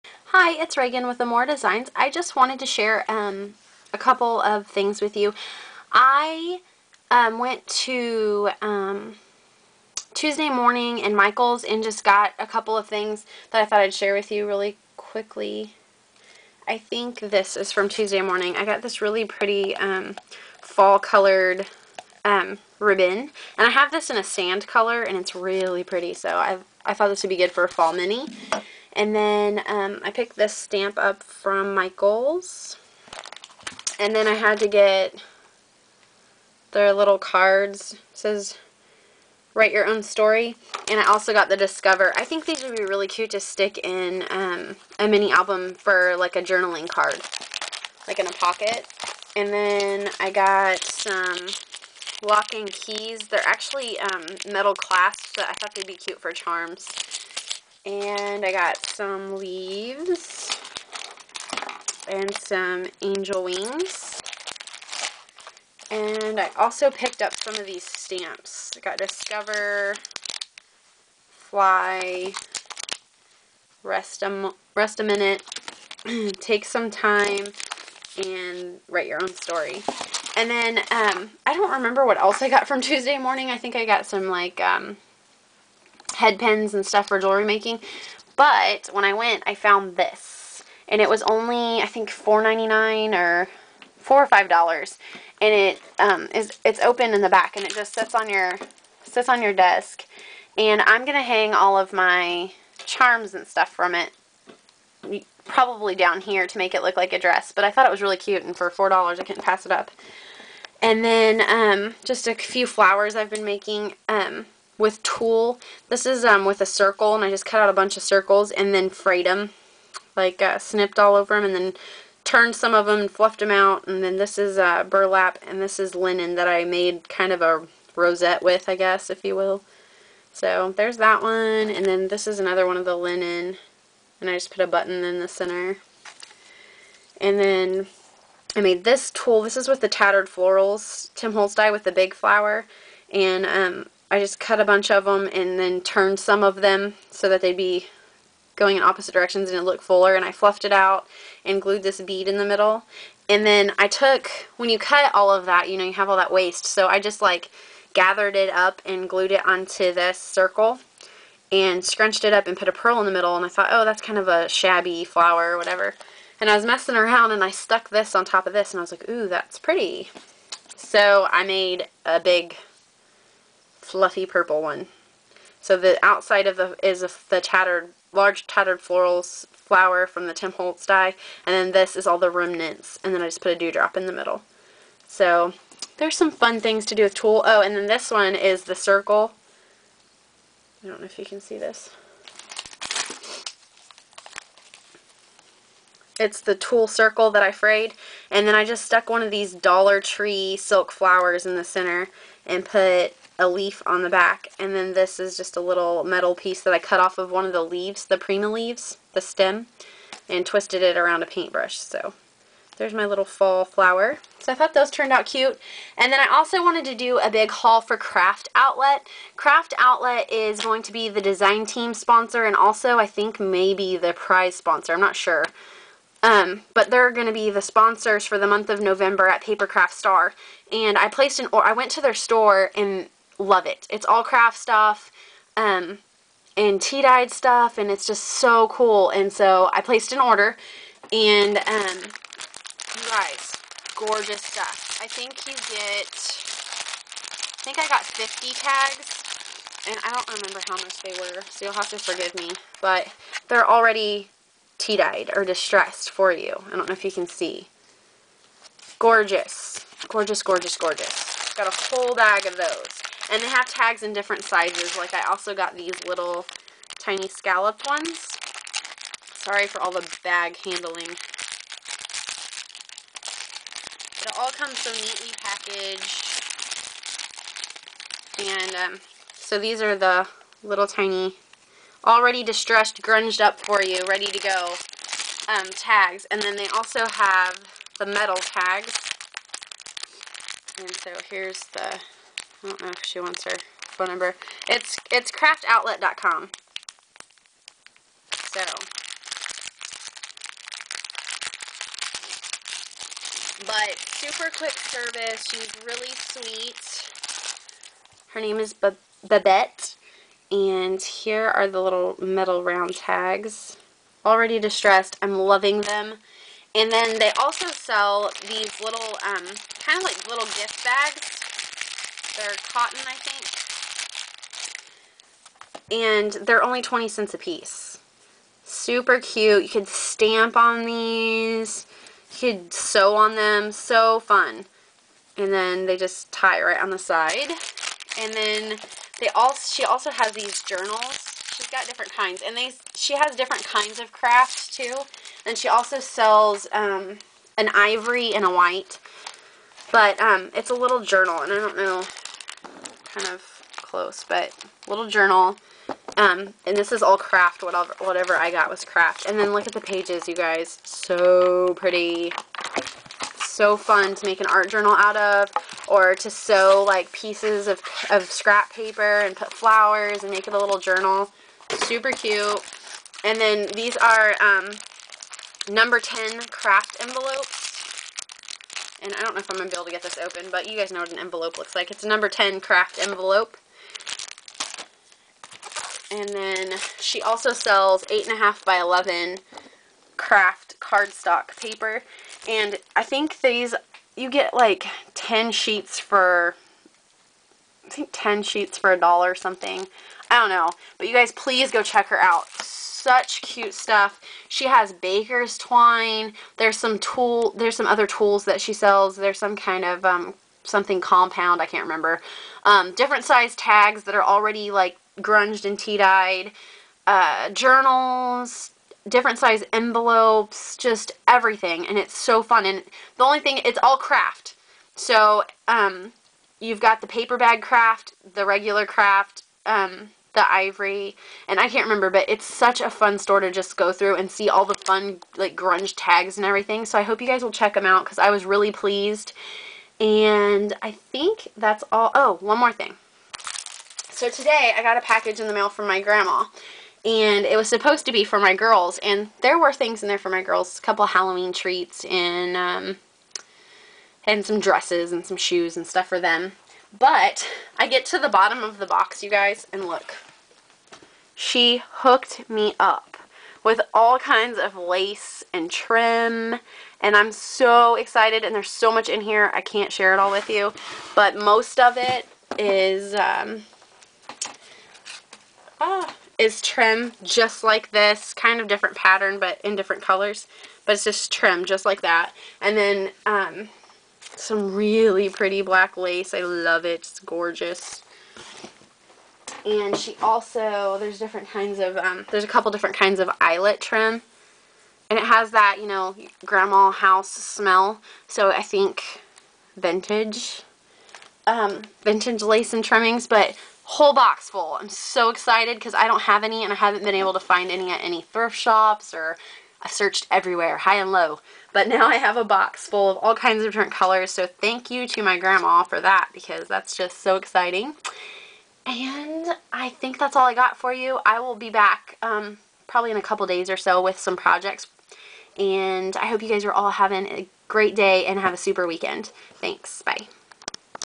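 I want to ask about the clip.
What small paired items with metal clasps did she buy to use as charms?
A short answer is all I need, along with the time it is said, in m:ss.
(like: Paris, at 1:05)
lock and keys, at 0:52.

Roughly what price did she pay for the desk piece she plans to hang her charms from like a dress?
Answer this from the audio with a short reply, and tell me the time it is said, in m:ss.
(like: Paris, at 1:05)
$4.99, at 1:32.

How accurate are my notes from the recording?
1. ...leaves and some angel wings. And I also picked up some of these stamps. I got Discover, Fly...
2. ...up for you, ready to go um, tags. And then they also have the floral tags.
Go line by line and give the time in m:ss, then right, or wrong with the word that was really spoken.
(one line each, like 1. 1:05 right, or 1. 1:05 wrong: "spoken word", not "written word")
1. 0:59 right
2. 4:43 wrong: "metal", not "floral".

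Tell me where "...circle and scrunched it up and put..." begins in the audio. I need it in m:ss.
2:40.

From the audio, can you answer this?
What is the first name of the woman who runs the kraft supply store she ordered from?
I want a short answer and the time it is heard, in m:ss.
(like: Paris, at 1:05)
Babette, at 5:08.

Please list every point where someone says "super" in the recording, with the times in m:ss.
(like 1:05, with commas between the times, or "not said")
5:03, 5:28, 6:11, 8:48.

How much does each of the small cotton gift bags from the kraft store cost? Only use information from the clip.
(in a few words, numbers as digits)
20 cents.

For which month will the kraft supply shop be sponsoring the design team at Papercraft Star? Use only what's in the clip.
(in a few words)
November.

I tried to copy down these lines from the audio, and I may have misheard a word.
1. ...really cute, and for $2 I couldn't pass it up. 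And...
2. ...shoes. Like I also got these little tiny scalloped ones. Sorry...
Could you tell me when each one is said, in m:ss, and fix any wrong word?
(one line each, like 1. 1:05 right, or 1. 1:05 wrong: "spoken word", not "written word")
1. 1:48 wrong: "4", not "2"
2. 4:24 wrong: "sizes", not "shoes".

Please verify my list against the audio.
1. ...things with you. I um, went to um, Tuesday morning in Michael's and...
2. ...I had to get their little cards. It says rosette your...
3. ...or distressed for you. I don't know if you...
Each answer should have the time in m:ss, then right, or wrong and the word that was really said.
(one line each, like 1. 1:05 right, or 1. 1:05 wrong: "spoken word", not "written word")
1. 0:04 right
2. 0:34 wrong: "write", not "rosette"
3. 4:15 right.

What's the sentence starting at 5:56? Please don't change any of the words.
Um, and this is all kraft, whatever, whatever I got was kraft.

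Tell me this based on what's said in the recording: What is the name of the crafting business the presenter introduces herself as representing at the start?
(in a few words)
Emora Designs.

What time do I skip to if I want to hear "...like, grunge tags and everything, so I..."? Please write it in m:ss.
7:15.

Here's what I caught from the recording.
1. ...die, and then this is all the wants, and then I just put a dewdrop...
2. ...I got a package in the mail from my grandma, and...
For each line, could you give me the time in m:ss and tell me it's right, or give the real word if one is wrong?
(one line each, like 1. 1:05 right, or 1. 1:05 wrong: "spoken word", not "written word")
1. 3:00 wrong: "remnants", not "wants"
2. 7:24 right.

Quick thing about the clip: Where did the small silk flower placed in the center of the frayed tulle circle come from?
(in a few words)
Dollar Tree.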